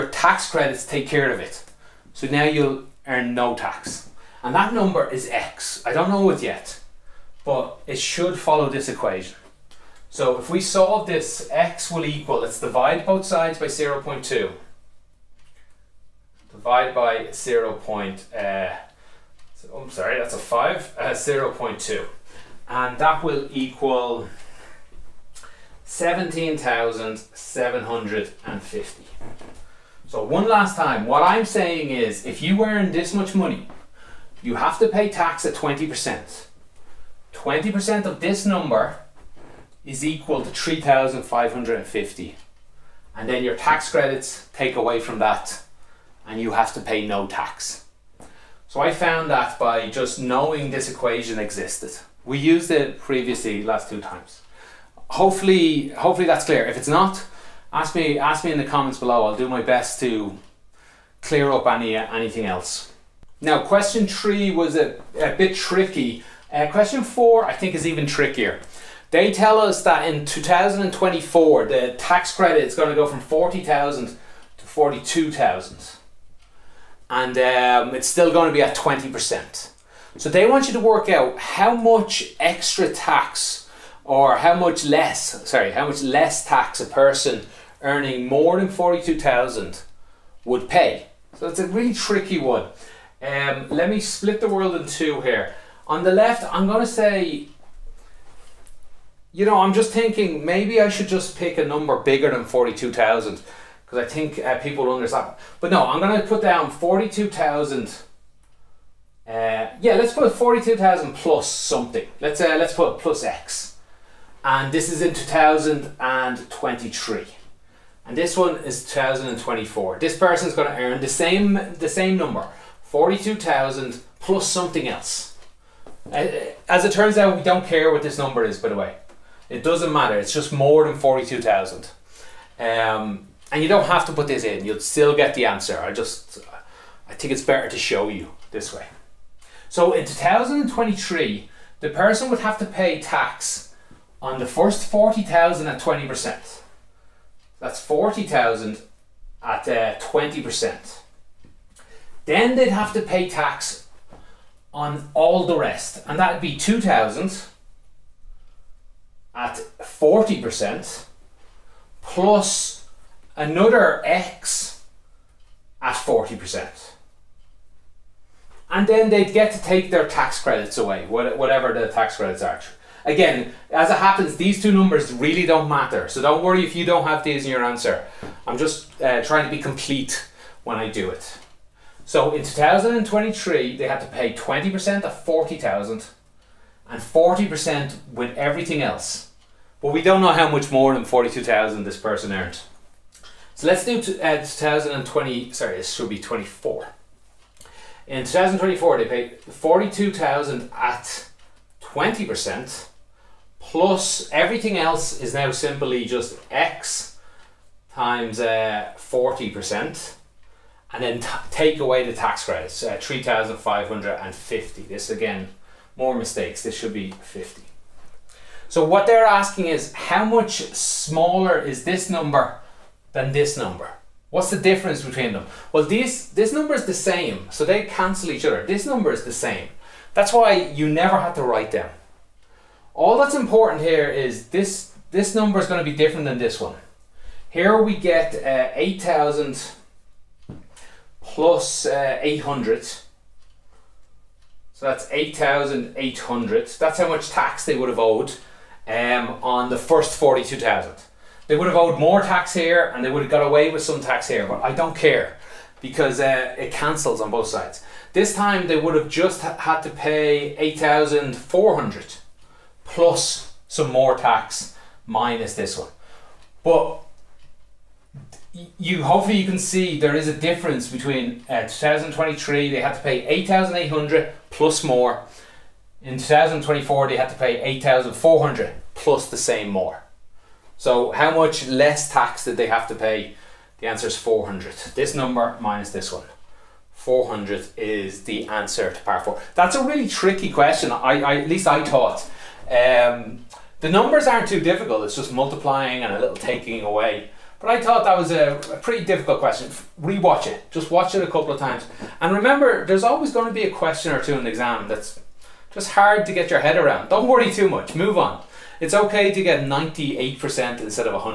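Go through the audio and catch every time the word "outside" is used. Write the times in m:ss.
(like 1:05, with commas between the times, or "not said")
not said.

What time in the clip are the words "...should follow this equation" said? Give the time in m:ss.
0:07.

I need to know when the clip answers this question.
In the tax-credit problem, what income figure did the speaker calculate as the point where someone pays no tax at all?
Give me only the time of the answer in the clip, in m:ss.
0:25.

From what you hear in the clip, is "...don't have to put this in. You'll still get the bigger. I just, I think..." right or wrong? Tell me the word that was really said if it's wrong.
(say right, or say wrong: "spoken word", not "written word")
wrong: "answer", not "bigger".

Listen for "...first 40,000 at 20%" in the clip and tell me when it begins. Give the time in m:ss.
2:24.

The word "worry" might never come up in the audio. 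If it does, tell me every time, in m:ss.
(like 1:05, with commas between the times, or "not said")
2:56, 5:07.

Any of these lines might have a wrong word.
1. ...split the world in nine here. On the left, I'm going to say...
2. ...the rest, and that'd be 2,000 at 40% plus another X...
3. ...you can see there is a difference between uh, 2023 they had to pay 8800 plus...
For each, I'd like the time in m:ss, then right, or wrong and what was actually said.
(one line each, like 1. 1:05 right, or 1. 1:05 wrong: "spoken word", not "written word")
1. 1:33 wrong: "two", not "nine"
2. 2:35 right
3. 4:29 right.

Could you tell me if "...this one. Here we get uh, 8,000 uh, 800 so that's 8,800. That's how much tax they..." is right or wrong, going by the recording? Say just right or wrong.
right.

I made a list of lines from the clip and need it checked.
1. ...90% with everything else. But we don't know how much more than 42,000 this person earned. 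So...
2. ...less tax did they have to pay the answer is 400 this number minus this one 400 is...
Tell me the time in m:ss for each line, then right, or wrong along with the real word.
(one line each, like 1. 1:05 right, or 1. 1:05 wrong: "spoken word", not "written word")
1. 3:07 wrong: "40", not "90"
2. 4:41 right.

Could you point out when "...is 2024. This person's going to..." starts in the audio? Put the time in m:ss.
1:58.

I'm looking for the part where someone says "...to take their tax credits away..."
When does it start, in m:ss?
2:49.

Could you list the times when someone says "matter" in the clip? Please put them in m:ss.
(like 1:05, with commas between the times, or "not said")
2:09, 2:55.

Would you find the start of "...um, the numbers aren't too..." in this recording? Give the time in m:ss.
4:52.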